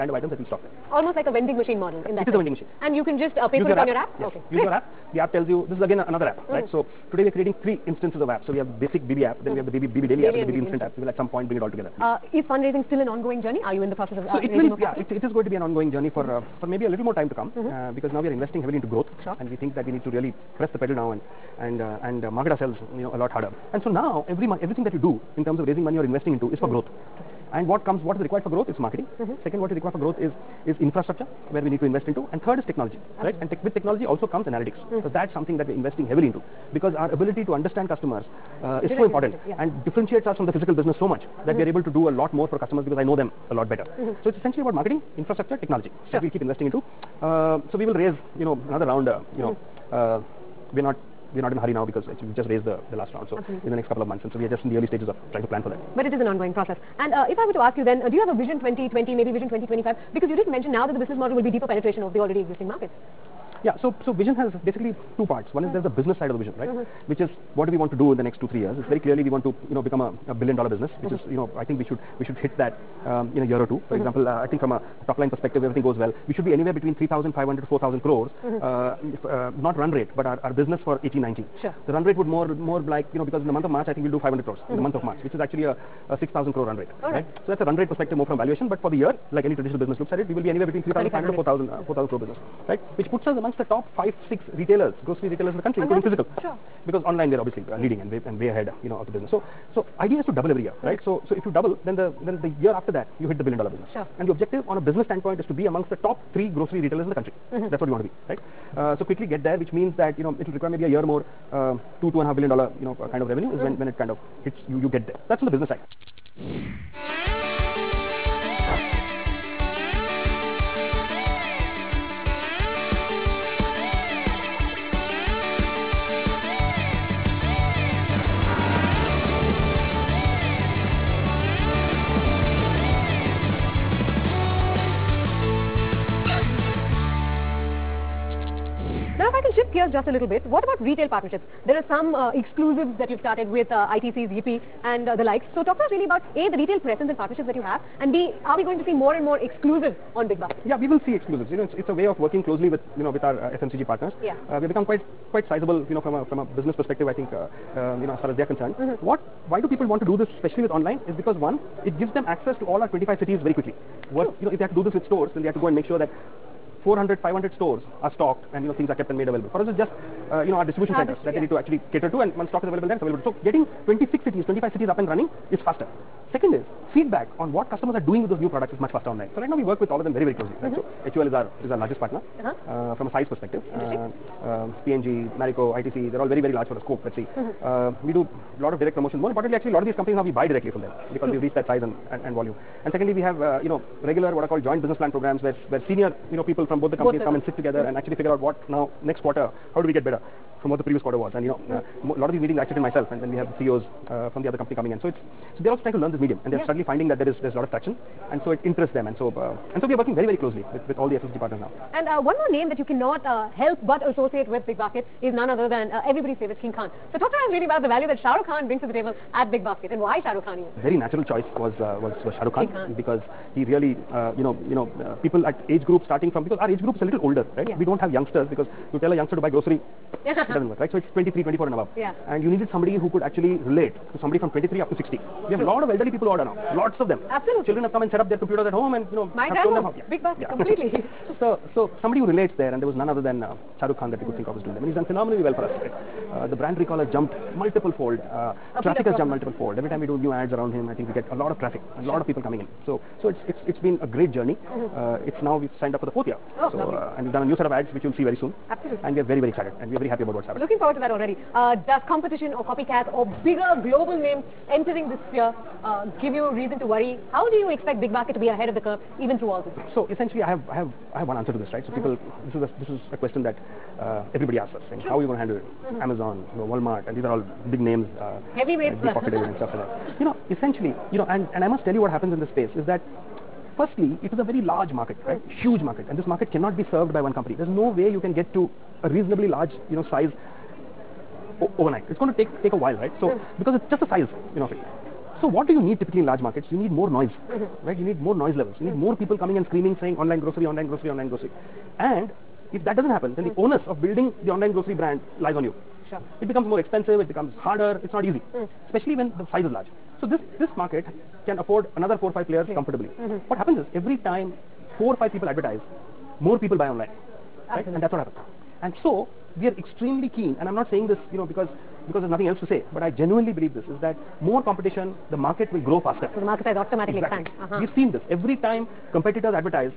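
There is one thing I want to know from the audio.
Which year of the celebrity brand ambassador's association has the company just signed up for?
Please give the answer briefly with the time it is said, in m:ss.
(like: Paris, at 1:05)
4th year, at 4:16.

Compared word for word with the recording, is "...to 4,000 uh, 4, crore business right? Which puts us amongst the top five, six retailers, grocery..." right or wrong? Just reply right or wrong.
right.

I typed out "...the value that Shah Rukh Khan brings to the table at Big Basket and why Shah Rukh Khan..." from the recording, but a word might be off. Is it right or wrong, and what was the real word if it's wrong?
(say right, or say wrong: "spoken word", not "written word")
right.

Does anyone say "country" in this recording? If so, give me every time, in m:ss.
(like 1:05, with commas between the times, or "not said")
1:35, 1:47.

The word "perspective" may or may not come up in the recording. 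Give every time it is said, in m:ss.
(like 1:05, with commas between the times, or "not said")
1:15, 1:27, 2:36, 3:03.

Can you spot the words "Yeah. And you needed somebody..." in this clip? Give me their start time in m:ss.
3:51.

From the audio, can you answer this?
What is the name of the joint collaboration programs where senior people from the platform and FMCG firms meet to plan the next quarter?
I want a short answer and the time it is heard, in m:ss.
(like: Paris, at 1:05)
joint business plan programs, at 3:14.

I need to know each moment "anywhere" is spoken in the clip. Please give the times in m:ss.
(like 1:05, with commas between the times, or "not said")
1:16, 1:30.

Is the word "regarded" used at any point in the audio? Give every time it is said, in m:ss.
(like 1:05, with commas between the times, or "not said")
not said.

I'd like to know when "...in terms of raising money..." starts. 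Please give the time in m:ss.
0:25.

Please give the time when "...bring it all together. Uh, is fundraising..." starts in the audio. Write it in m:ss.
0:11.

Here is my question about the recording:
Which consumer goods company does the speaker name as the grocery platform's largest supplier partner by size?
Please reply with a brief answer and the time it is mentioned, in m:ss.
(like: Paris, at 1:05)
HUL, at 3:01.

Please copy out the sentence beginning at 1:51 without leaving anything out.
Um, two two and a half billion dollar you know kind of revenue is mm.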